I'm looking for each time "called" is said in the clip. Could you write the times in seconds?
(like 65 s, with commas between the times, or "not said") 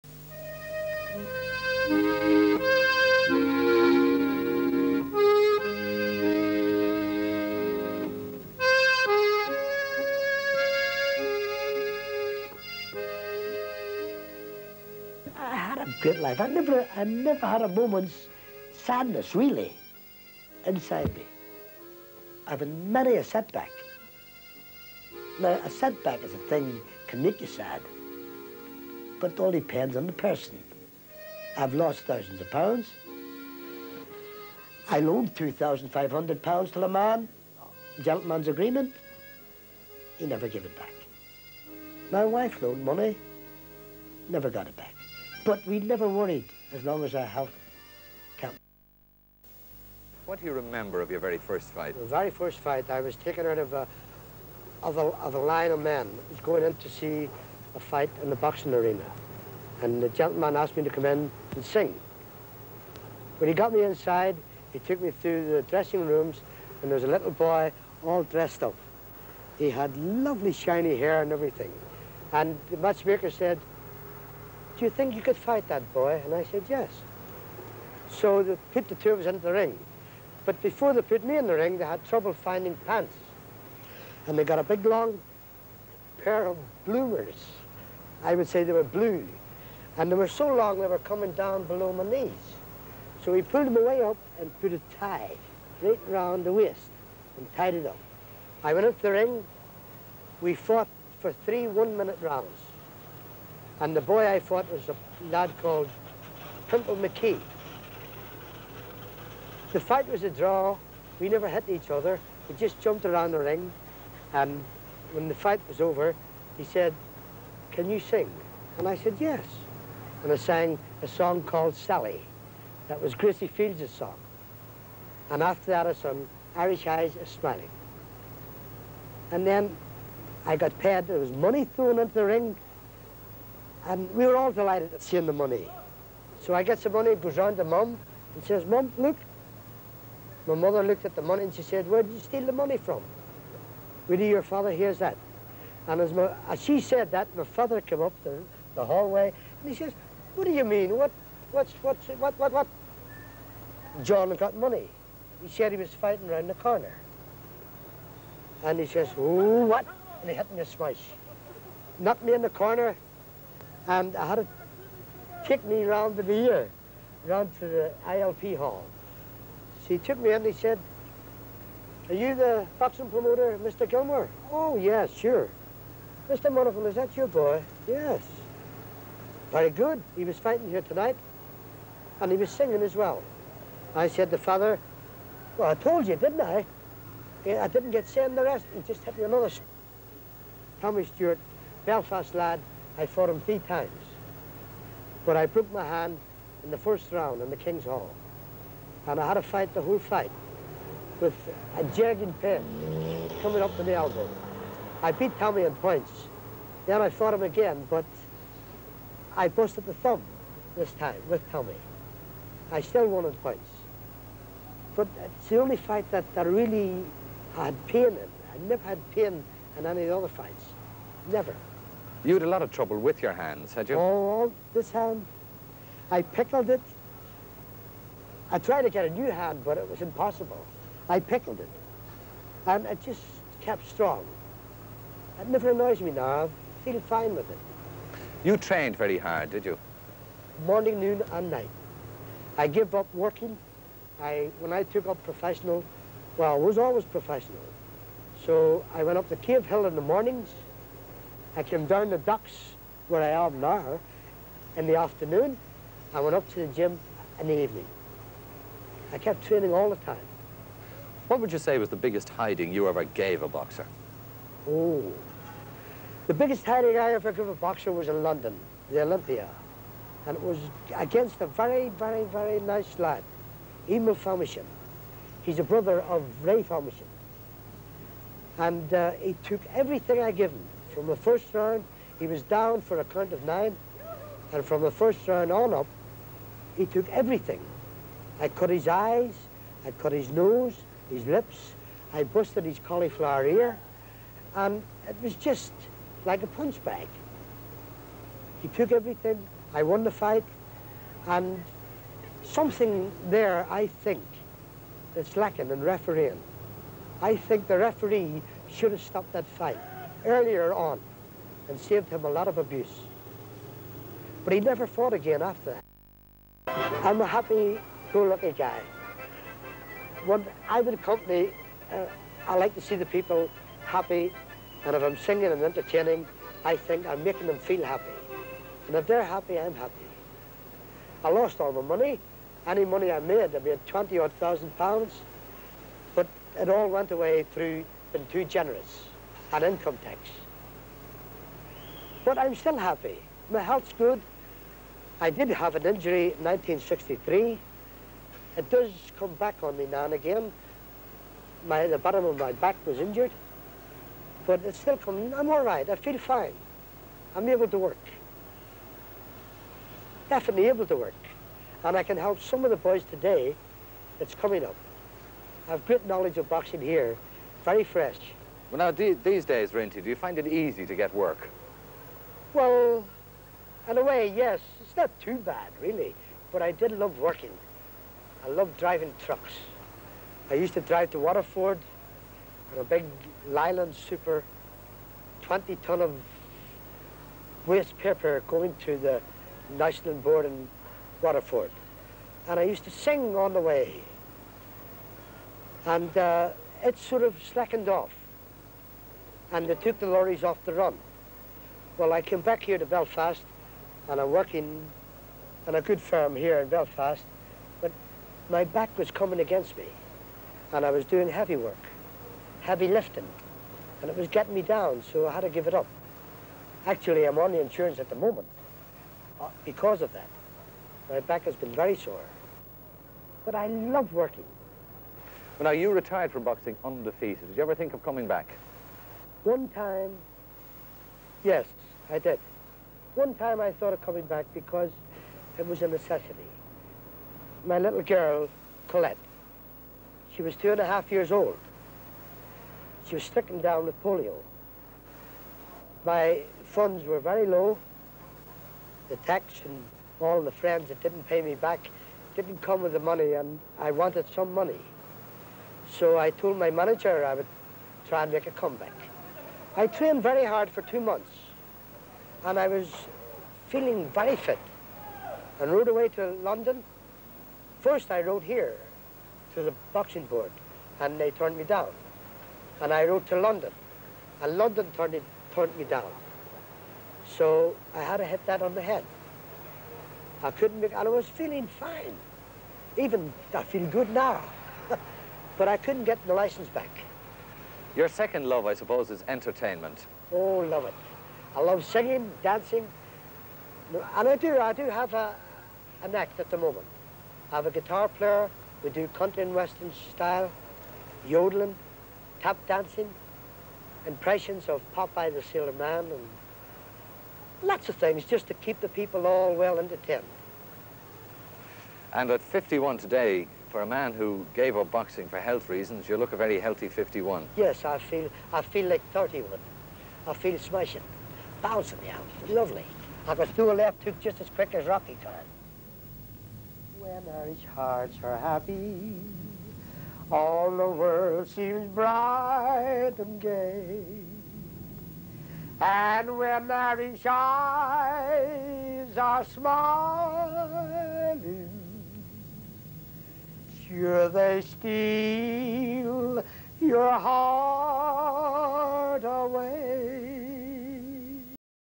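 105 s, 121 s.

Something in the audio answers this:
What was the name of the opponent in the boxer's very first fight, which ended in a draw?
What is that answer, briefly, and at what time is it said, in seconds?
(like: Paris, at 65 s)
Pimple McKee, at 106 s.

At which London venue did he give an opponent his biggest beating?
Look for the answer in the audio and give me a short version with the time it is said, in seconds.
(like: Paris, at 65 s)
Olympia, at 269 s.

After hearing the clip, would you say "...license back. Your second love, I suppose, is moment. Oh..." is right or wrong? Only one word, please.
wrong.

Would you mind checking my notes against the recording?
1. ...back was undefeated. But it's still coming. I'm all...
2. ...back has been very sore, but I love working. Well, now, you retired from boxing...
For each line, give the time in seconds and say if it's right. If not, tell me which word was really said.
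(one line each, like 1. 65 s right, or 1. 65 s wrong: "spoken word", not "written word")
1. 352 s wrong: "injured", not "undefeated"
2. 421 s right.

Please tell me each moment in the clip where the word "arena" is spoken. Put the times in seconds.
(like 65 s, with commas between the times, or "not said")
58 s.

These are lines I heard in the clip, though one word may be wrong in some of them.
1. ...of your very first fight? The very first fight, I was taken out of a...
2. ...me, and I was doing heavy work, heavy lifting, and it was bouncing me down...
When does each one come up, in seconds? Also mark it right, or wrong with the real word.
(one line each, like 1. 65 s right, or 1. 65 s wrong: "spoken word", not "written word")
1. 51 s right
2. 409 s wrong: "getting", not "bouncing".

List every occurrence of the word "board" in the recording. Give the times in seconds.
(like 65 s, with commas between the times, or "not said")
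390 s, 470 s.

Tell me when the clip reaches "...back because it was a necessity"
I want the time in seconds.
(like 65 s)
434 s.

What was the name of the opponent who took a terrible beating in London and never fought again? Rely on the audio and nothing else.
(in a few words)
Emil Famechon.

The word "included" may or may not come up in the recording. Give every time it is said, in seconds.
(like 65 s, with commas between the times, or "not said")
not said.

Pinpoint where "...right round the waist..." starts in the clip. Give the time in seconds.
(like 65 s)
95 s.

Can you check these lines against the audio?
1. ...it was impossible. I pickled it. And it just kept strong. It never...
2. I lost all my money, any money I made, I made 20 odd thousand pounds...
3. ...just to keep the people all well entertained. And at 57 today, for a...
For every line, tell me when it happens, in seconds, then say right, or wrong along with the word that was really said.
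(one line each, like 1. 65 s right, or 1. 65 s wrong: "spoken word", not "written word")
1. 229 s right
2. 331 s right
3. 508 s wrong: "51", not "57".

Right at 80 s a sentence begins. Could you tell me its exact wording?
But before they put me in the ring, they had trouble finding pants.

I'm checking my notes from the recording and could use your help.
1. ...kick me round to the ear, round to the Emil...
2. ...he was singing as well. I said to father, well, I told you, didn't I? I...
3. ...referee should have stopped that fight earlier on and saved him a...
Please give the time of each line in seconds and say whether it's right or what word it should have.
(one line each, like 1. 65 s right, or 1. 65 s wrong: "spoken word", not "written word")
1. 165 s wrong: "ILP", not "Emil"
2. 182 s right
3. 307 s right.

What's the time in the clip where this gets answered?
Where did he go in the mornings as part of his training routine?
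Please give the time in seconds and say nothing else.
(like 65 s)
249 s.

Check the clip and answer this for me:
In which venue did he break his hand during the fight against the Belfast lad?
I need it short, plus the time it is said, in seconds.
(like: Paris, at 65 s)
King's Hall, at 197 s.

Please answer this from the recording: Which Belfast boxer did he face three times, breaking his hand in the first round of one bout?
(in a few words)
Tommy Stewart.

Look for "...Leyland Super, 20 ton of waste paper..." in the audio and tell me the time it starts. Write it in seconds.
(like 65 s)
383 s.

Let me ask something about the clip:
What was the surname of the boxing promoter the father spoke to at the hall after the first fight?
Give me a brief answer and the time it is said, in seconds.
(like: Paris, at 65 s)
Gilmore, at 173 s.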